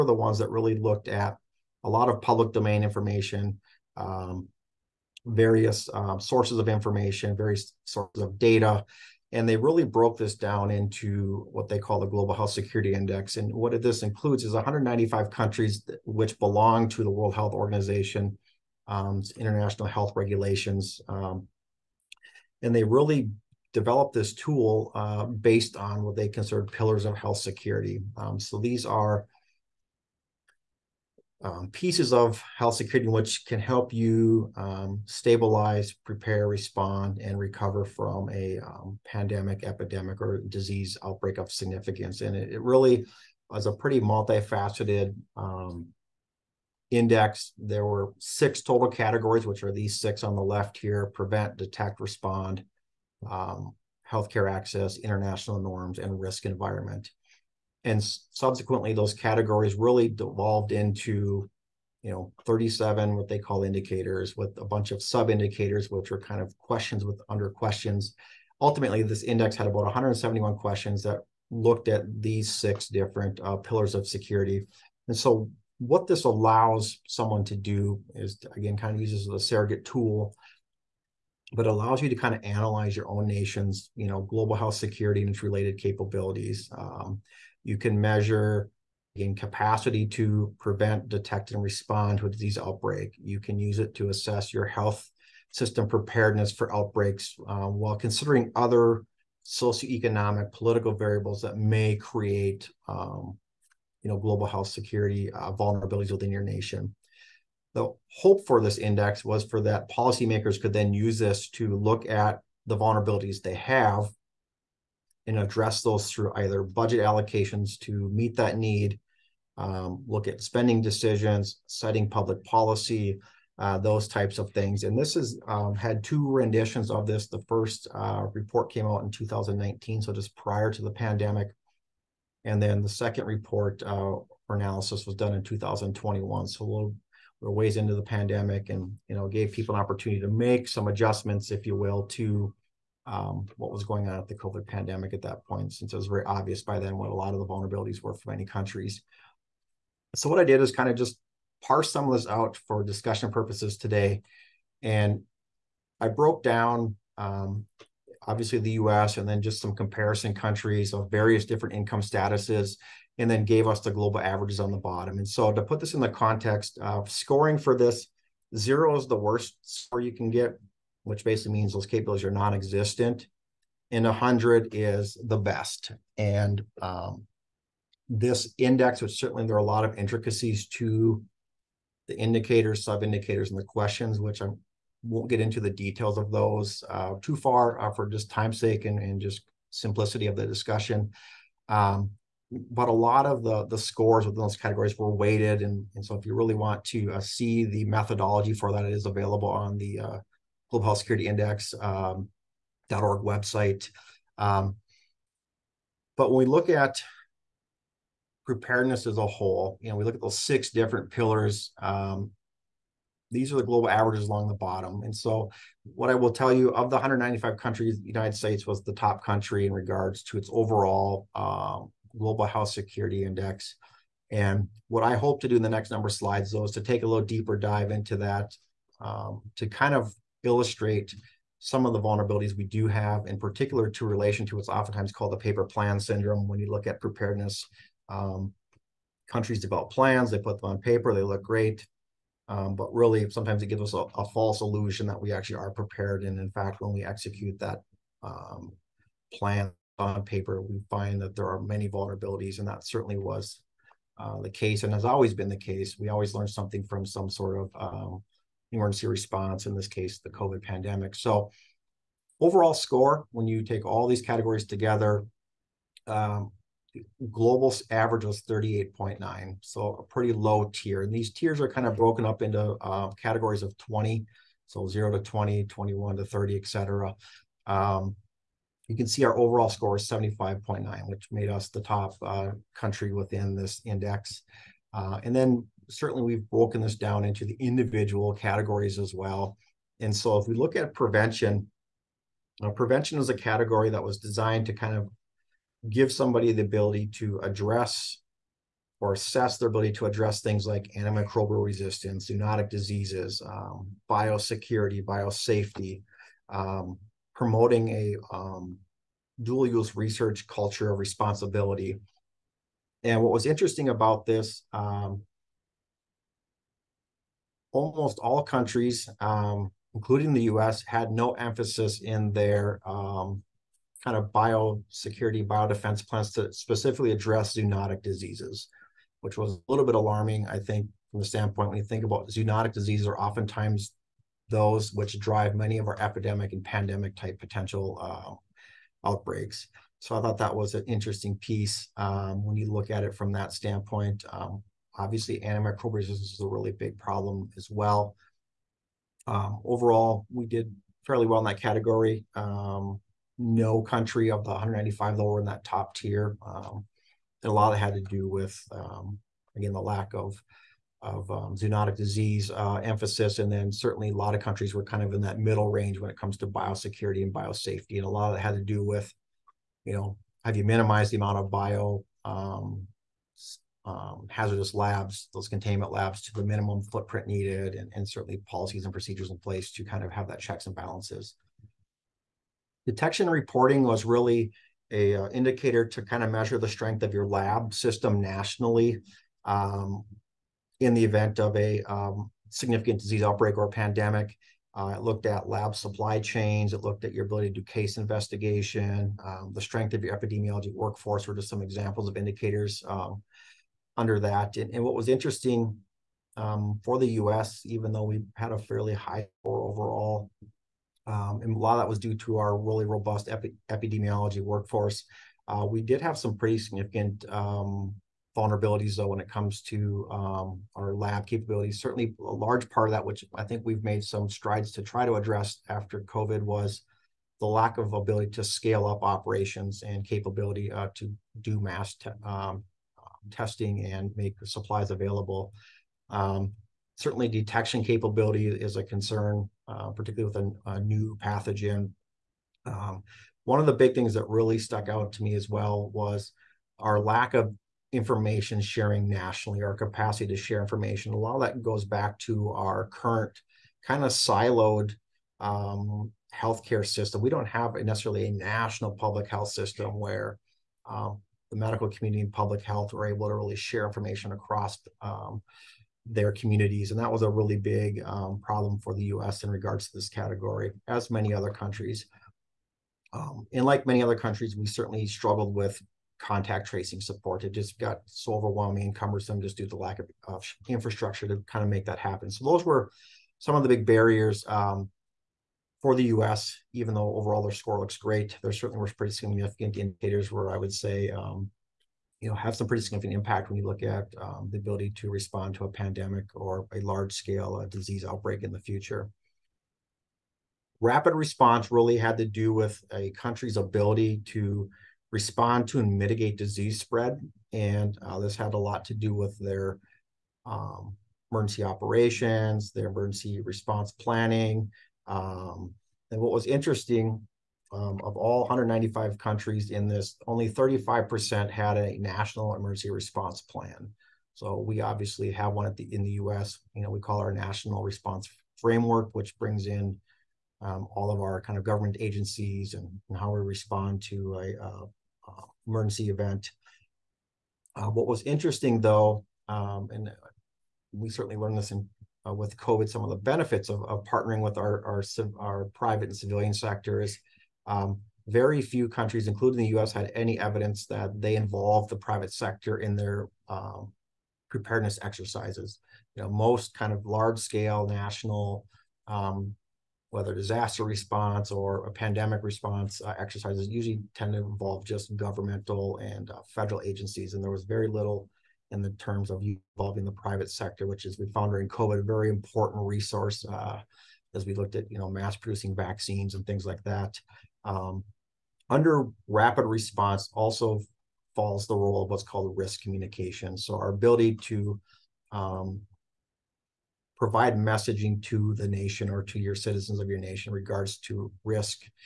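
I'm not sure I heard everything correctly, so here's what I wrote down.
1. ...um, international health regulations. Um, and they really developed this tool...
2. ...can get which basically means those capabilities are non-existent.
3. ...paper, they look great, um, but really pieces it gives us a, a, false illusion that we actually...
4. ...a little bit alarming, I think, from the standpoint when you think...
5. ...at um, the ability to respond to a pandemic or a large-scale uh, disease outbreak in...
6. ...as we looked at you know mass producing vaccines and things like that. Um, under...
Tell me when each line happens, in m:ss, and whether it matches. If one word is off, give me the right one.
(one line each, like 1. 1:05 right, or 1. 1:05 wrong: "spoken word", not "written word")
1. 0:18 right
2. 2:50 right
3. 4:00 wrong: "sometimes", not "pieces"
4. 5:29 right
5. 8:13 right
6. 9:34 right.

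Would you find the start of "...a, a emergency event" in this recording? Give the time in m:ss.
8:54.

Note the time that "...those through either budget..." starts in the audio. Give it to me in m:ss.
1:55.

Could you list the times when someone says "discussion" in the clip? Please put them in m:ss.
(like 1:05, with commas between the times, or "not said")
2:32, 3:10.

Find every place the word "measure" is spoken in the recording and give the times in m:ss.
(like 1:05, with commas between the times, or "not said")
1:27, 6:26.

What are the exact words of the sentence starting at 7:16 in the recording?
Um, certainly, detection capability is a concern, uh, particularly with a, a new pathogen.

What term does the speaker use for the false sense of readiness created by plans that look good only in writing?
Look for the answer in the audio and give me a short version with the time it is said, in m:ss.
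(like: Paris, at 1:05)
paper plan syndrome, at 3:55.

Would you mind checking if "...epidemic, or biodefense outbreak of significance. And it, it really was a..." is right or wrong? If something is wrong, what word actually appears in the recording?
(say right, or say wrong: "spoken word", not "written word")
wrong: "disease", not "biodefense".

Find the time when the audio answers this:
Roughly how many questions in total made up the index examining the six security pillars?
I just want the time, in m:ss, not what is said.
1:09.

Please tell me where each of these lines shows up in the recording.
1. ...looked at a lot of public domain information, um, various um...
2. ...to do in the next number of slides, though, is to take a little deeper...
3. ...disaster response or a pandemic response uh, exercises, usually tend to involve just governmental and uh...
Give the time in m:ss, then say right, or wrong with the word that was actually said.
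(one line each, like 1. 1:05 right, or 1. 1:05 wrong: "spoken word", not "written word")
1. 0:00 right
2. 3:45 right
3. 9:20 right.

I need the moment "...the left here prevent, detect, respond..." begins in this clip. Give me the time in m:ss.
0:50.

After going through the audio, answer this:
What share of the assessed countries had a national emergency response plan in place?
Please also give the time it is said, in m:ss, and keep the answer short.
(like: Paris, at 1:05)
35%, at 8:40.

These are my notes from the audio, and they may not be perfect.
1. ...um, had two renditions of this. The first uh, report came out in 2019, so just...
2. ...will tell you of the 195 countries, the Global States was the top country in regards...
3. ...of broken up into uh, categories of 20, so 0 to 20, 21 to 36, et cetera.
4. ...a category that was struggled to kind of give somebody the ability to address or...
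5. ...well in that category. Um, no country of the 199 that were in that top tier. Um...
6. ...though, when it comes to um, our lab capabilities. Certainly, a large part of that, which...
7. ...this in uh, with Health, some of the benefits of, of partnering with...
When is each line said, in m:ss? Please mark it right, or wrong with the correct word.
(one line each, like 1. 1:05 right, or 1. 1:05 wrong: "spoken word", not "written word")
1. 2:05 right
2. 3:36 wrong: "United", not "Global"
3. 4:31 wrong: "30", not "36"
4. 4:53 wrong: "designed", not "struggled"
5. 5:51 wrong: "195", not "199"
6. 6:58 right
7. 9:01 wrong: "COVID", not "Health".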